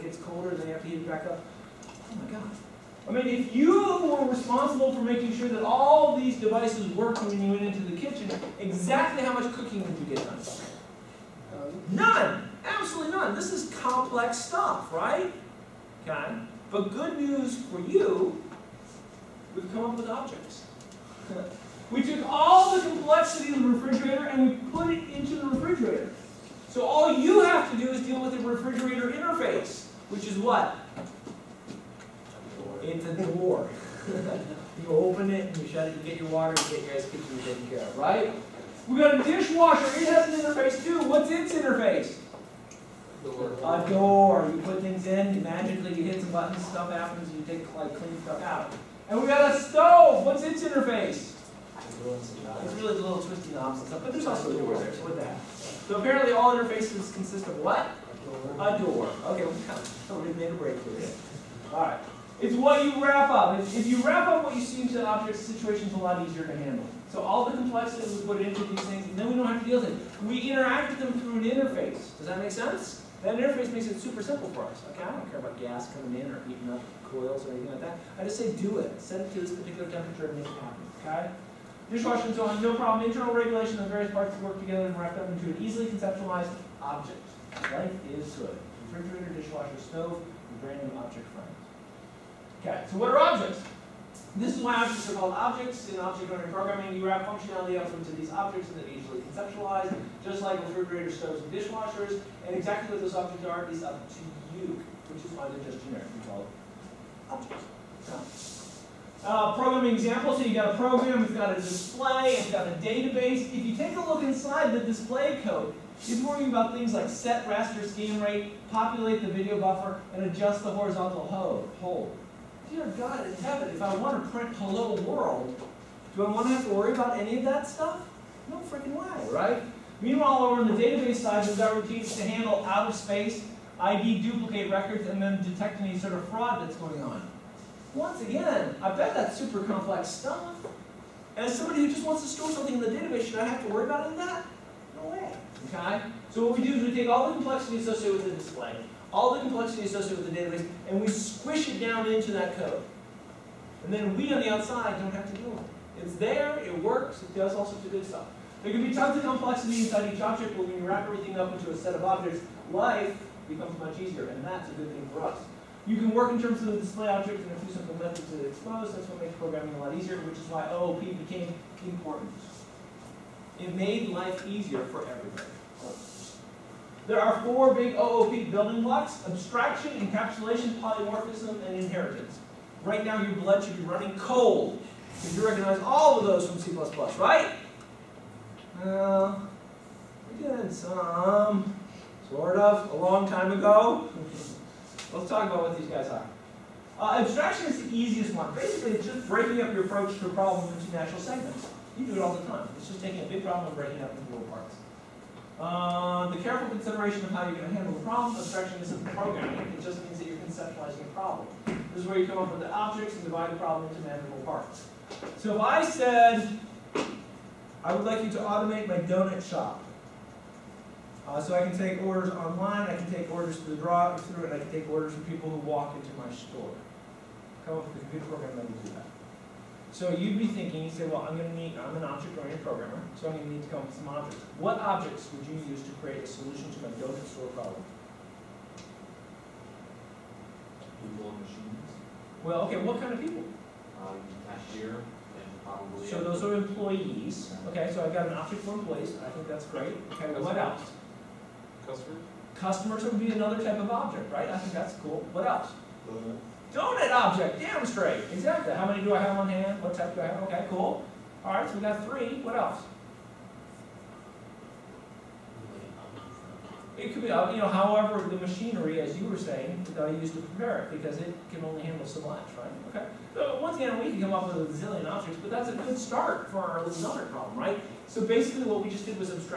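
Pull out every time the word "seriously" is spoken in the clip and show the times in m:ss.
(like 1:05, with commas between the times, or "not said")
not said.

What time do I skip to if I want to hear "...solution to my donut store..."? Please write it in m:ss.
3:56.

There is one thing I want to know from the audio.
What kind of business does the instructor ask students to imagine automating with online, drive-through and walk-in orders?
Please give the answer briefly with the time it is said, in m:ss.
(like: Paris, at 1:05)
donut shop, at 3:38.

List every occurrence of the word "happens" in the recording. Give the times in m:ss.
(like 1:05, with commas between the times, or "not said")
0:46, 1:20.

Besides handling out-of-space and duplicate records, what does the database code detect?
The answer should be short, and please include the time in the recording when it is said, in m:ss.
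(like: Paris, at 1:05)
fraud, at 2:16.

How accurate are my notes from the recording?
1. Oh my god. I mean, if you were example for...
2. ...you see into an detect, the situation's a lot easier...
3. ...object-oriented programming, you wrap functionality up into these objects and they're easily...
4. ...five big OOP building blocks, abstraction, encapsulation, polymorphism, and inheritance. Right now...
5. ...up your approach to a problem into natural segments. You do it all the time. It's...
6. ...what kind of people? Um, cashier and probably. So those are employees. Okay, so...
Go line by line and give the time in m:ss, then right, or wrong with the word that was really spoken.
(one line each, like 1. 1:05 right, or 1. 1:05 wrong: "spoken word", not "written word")
1. 0:01 wrong: "responsible", not "example"
2. 1:04 wrong: "object", not "detect"
3. 1:35 right
4. 2:57 wrong: "four", not "five"
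5. 3:19 right
6. 4:02 right.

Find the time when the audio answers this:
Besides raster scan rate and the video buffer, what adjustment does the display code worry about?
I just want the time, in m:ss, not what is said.
2:00.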